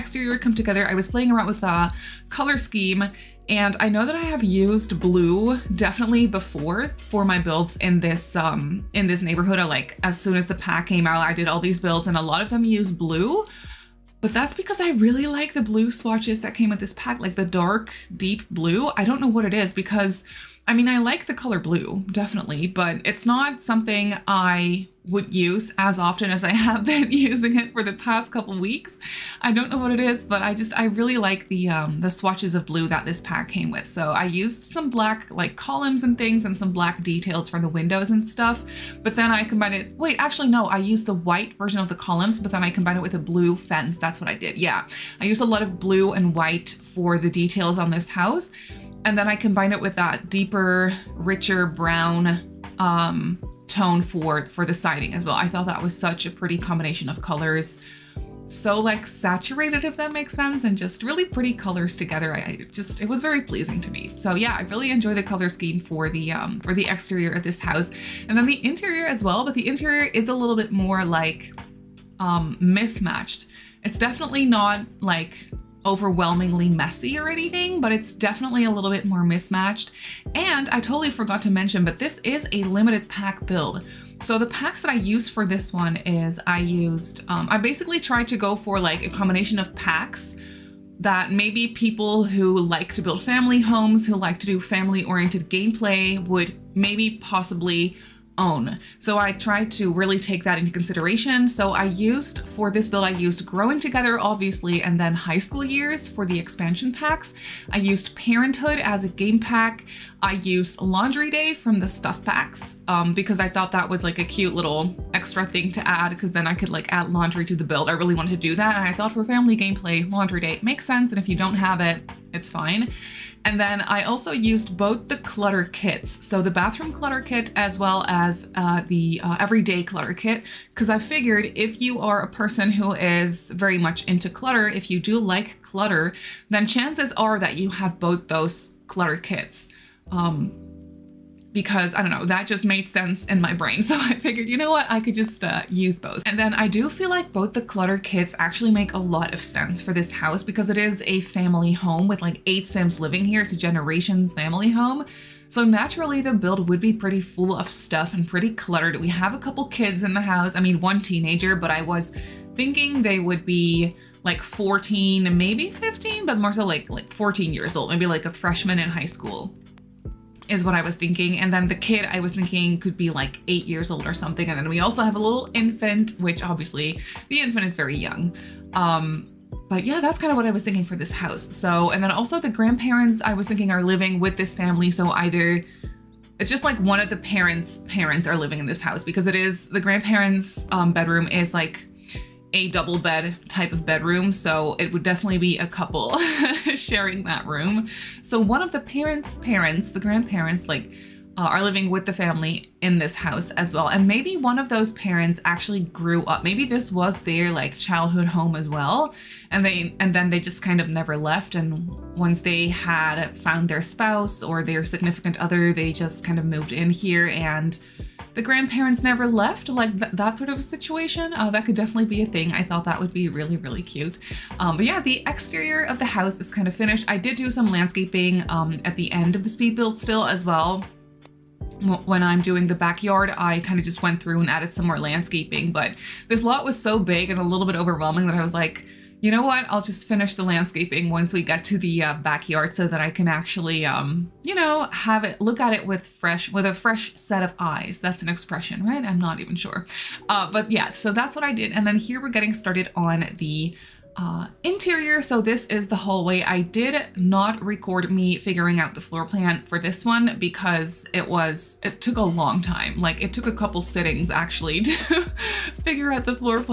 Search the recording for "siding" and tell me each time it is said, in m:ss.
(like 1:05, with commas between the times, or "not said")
0:54.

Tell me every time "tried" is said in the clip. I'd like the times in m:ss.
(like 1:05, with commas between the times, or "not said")
1:27, 1:39.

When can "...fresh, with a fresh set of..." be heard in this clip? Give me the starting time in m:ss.
4:06.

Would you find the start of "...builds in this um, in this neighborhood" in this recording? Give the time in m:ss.
0:07.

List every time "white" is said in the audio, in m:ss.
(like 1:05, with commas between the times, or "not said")
0:41, 0:46.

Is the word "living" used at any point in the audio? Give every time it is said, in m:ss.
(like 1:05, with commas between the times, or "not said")
2:33, 3:03, 3:08, 3:21.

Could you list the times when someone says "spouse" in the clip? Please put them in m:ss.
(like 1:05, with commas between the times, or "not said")
3:33.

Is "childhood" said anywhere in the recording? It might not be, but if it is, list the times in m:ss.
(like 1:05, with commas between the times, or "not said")
3:27.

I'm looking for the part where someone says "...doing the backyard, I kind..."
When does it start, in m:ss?
3:52.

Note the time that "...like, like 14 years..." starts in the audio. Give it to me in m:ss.
2:46.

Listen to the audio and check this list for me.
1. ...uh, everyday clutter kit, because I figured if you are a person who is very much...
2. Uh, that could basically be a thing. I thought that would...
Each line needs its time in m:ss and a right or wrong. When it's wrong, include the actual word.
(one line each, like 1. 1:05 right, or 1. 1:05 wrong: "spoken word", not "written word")
1. 2:09 right
2. 3:41 wrong: "definitely", not "basically".